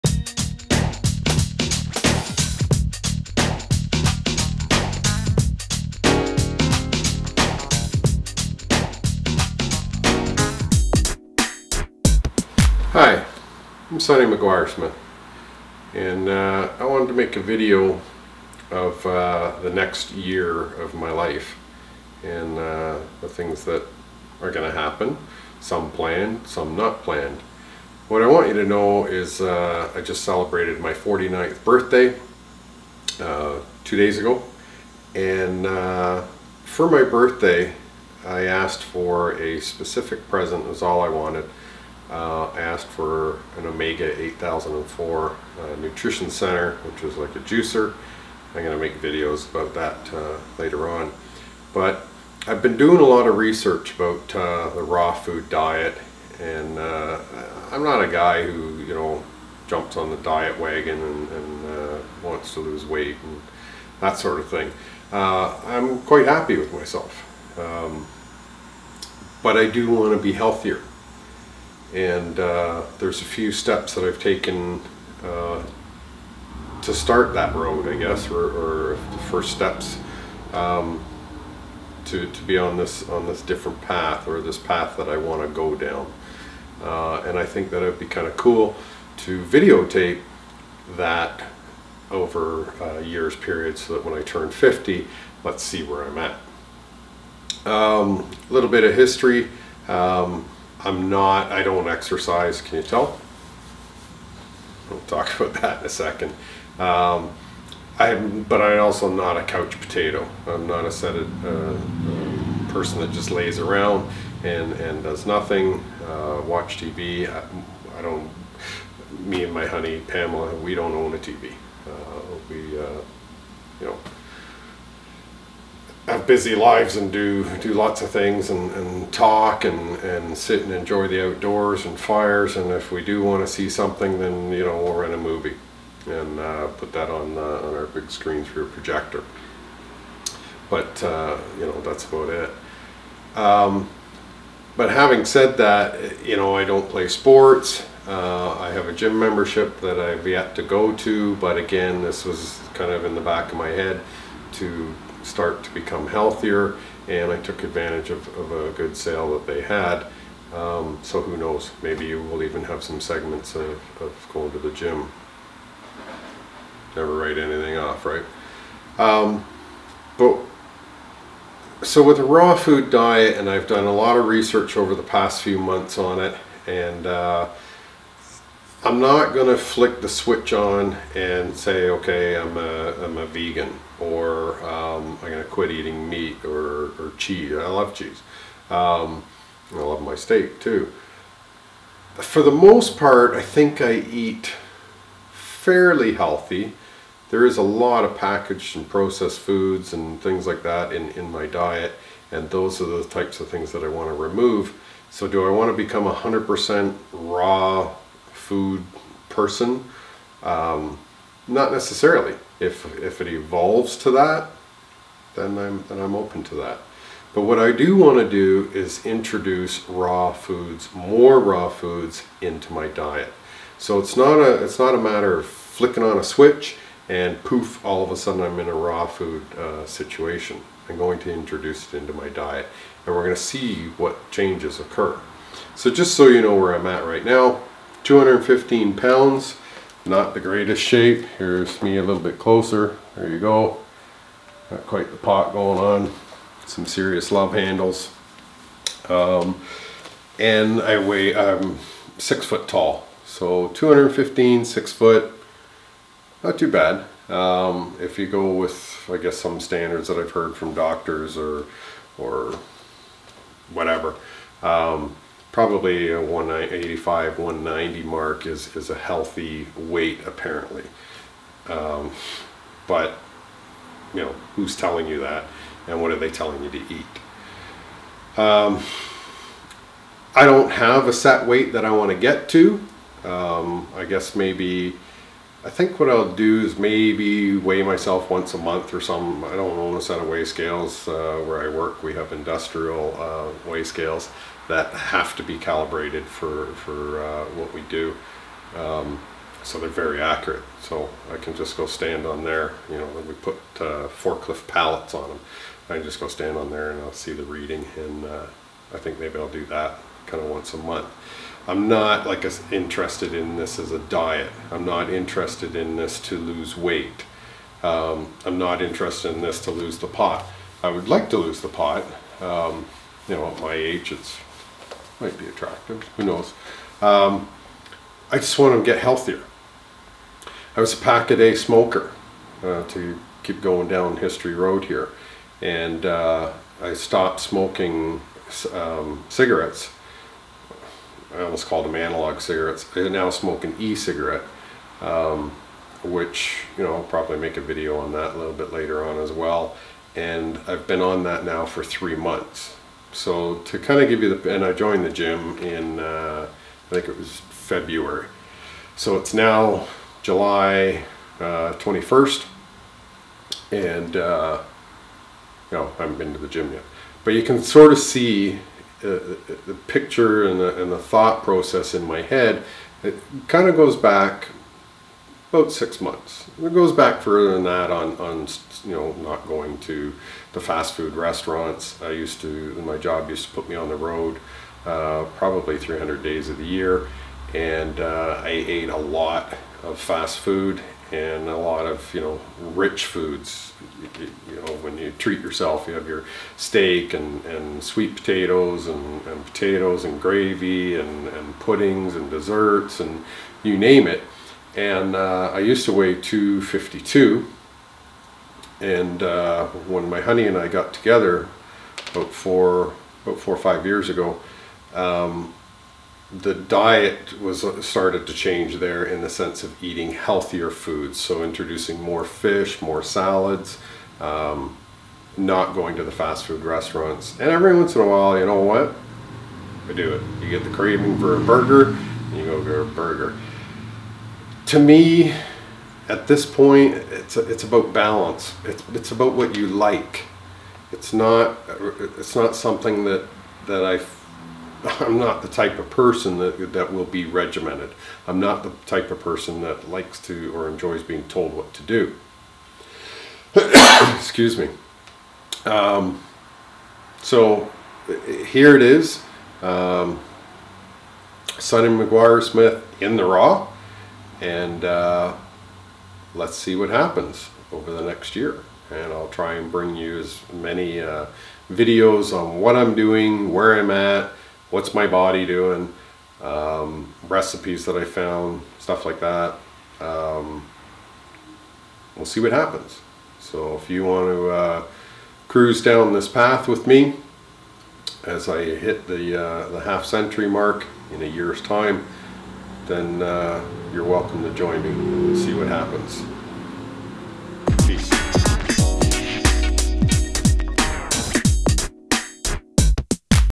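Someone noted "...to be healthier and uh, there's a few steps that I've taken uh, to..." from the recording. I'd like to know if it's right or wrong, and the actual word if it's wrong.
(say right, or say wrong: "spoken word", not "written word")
right.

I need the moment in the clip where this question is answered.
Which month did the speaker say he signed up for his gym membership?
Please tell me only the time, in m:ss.
5:57.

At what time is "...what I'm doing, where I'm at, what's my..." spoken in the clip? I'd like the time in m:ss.
7:52.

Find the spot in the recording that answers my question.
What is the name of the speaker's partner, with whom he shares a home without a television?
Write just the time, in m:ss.
2:00.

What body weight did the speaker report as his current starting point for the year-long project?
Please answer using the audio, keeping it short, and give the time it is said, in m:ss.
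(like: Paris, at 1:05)
215 pounds, at 3:58.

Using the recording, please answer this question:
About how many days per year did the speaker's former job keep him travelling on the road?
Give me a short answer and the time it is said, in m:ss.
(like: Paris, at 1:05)
300, at 6:25.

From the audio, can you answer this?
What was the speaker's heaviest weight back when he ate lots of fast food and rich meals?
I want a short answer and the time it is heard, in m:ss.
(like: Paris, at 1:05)
252, at 6:46.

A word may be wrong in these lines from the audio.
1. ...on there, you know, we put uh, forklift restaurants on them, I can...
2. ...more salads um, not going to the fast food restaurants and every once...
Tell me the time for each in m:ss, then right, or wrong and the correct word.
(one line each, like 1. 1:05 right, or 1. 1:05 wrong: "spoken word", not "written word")
1. 5:02 wrong: "pallets", not "restaurants"
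2. 7:02 right.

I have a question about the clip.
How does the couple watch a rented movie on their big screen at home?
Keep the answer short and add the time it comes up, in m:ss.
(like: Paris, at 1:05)
Through a projector, at 2:18.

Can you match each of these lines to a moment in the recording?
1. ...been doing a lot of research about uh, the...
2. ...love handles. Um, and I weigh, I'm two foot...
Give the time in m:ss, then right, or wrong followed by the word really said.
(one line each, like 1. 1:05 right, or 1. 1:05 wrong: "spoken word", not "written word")
1. 0:52 right
2. 4:07 wrong: "six", not "two".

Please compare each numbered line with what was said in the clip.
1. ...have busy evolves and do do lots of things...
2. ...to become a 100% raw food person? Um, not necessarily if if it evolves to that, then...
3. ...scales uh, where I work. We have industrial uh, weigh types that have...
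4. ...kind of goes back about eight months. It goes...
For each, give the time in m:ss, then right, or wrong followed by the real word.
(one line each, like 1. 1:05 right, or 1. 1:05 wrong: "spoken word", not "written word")
1. 2:06 wrong: "lives", not "evolves"
2. 3:25 right
3. 4:50 wrong: "scales", not "types"
4. 6:13 wrong: "six", not "eight".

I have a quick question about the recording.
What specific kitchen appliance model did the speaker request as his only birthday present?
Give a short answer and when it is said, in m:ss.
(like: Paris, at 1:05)
Omega 8004, at 0:43.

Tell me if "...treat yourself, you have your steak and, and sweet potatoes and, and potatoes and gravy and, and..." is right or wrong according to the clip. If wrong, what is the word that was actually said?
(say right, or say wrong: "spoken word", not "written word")
right.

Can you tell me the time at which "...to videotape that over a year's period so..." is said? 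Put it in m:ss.
1:29.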